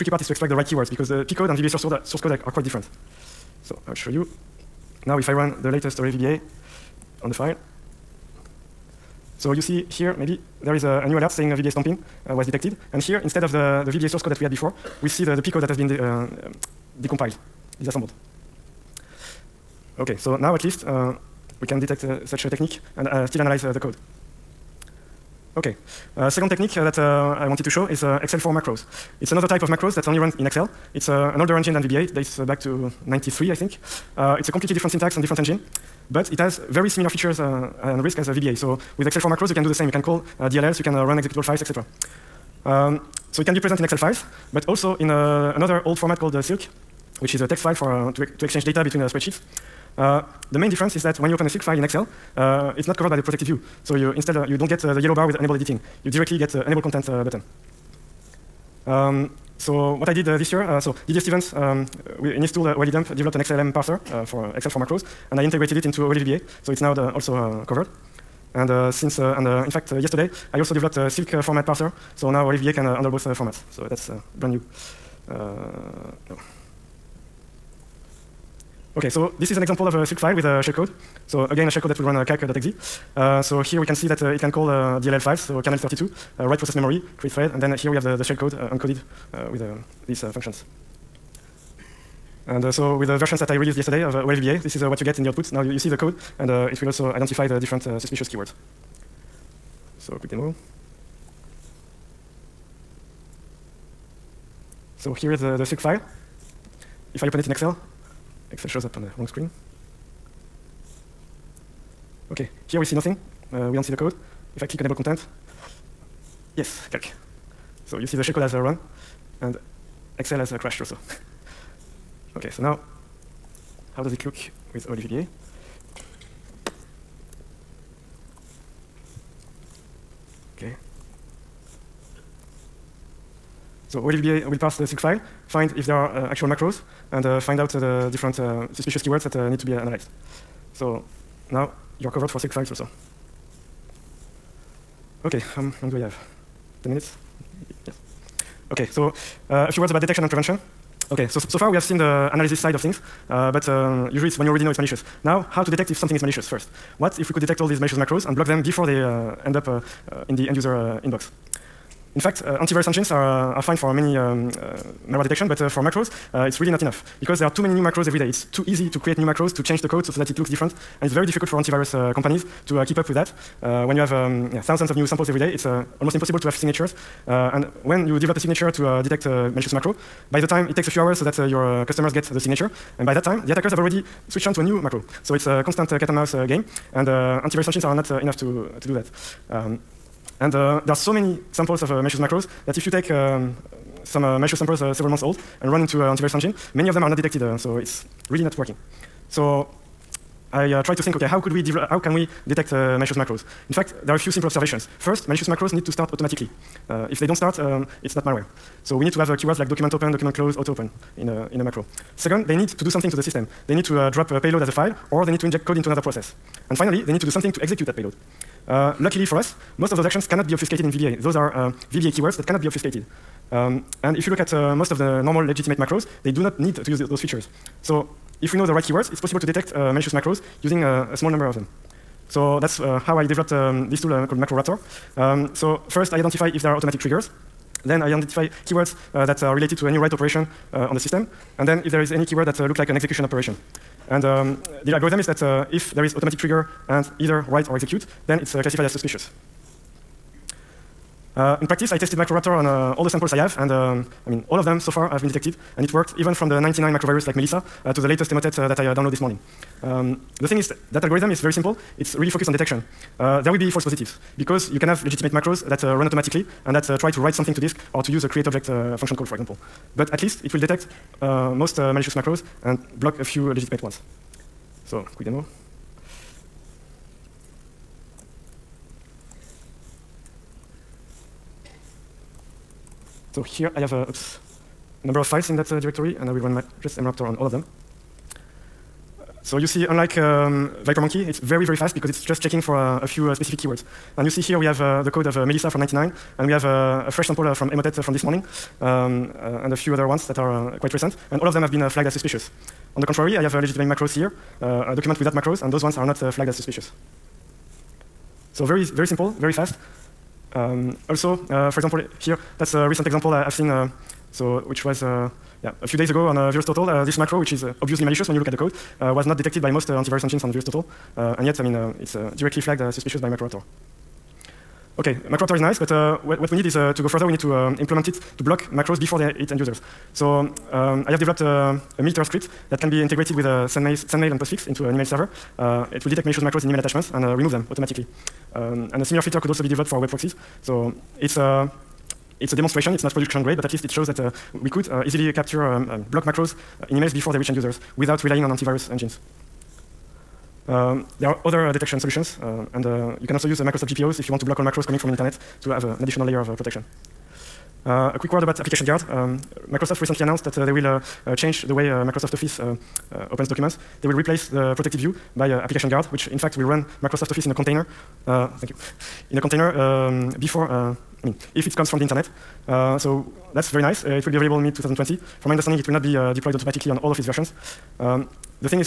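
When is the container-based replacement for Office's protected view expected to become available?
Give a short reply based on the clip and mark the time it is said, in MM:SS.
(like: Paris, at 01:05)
mid 2020, at 06:14.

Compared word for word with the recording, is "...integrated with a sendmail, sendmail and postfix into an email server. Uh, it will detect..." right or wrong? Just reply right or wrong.
right.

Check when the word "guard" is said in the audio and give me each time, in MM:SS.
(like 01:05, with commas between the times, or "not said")
05:58, 06:05.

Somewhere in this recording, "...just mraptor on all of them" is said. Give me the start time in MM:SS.
04:46.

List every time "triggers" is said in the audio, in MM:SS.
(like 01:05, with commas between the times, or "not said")
03:57, 04:06.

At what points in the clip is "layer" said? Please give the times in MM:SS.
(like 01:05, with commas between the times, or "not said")
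05:56.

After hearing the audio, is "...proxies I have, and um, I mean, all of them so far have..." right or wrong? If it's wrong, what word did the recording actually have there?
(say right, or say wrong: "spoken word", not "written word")
wrong: "samples", not "proxies".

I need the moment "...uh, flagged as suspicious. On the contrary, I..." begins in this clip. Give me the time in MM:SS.
05:01.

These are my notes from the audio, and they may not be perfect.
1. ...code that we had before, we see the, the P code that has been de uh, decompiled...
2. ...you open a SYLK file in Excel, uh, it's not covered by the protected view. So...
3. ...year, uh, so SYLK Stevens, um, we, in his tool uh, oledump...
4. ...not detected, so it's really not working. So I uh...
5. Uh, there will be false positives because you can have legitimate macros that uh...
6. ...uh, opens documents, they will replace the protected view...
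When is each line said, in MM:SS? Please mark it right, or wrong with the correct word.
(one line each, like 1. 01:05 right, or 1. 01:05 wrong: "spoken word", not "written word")
1. 00:14 right
2. 00:51 right
3. 01:00 wrong: "Didier", not "SYLK"
4. 03:17 right
5. 04:23 right
6. 06:03 right.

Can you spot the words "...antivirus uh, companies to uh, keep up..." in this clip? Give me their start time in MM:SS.
02:51.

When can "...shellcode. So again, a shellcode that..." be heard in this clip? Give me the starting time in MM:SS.
01:20.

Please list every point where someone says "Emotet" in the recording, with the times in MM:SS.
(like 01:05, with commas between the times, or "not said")
04:18, 04:57.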